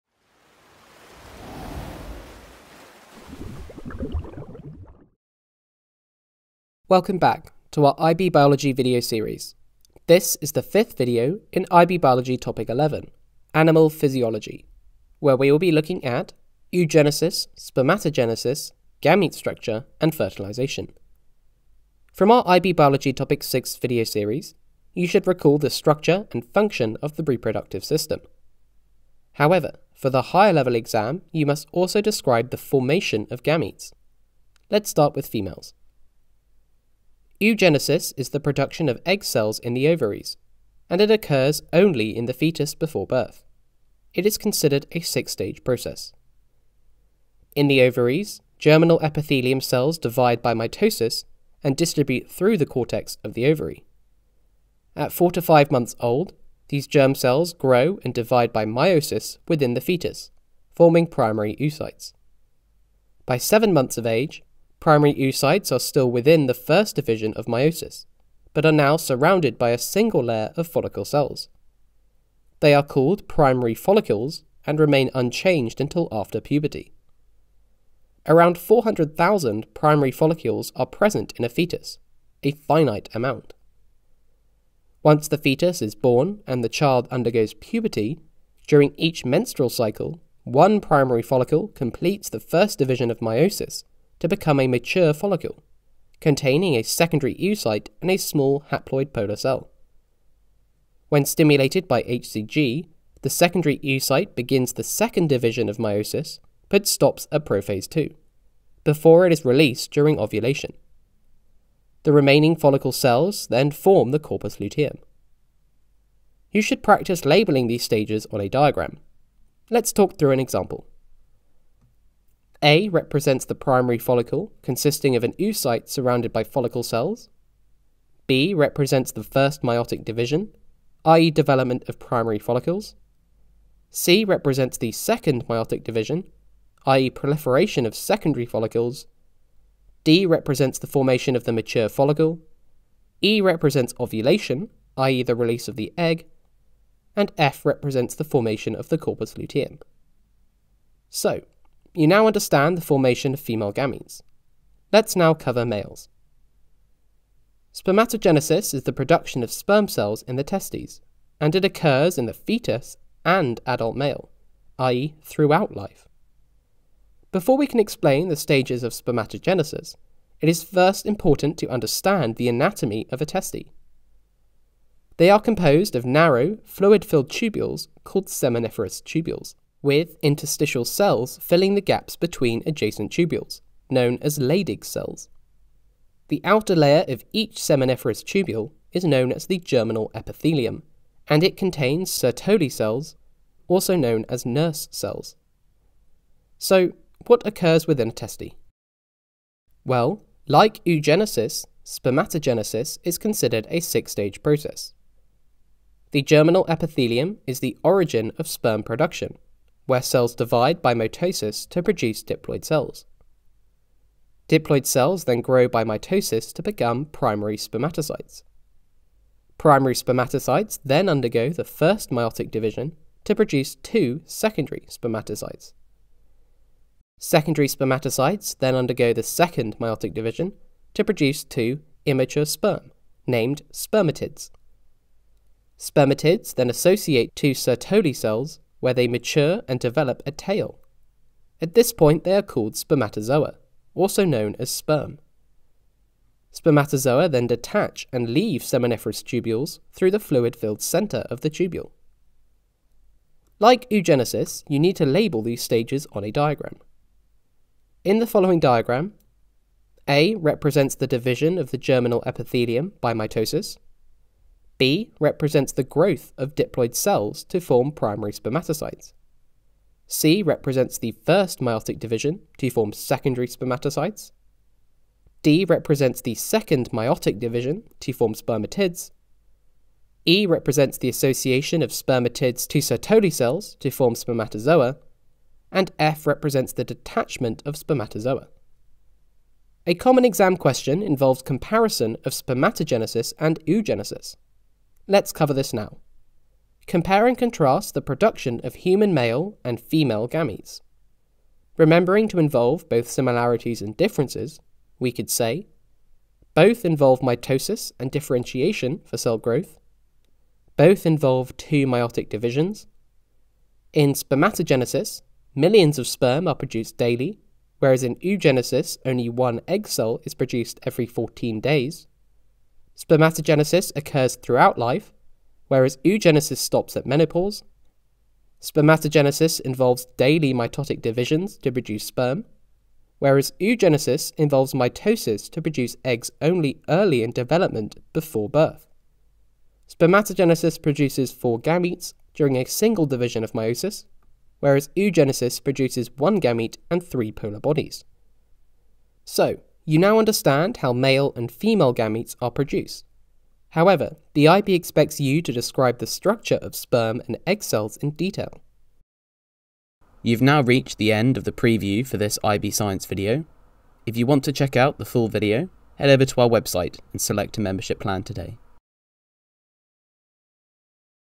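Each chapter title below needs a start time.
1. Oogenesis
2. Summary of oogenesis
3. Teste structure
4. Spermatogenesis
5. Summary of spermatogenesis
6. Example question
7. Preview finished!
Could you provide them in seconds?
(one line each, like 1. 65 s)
1. 32 s
2. 118 s
3. 155 s
4. 205 s
5. 257 s
6. 294 s
7. 358 s.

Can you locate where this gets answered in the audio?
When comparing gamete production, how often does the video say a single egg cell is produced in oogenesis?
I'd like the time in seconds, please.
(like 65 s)
320 s.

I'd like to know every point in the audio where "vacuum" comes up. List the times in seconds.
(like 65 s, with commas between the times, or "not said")
not said.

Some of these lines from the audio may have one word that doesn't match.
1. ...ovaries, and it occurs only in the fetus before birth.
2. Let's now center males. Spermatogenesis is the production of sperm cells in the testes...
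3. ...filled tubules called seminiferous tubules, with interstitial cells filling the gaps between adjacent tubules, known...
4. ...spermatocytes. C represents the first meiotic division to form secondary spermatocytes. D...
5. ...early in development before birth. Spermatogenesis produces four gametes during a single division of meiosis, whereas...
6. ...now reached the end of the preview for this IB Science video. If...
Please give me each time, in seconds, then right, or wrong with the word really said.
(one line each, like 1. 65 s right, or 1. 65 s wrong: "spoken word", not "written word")
1. 39 s right
2. 154 s wrong: "cover", not "center"
3. 177 s right
4. 268 s right
5. 336 s right
6. 360 s right.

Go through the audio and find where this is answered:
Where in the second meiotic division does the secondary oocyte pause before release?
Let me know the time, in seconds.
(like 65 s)
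107 s.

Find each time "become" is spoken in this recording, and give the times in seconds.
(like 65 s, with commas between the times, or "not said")
94 s, 216 s.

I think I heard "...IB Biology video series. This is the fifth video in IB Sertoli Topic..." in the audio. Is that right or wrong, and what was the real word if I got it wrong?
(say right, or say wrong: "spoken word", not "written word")
wrong: "Biology", not "Sertoli".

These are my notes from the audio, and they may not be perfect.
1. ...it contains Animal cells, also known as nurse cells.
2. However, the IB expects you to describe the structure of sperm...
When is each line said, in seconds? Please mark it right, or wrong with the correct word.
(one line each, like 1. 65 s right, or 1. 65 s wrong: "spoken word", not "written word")
1. 191 s wrong: "Sertoli", not "Animal"
2. 353 s right.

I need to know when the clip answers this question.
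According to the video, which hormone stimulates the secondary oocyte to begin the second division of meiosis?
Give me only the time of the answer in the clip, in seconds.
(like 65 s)
102 s.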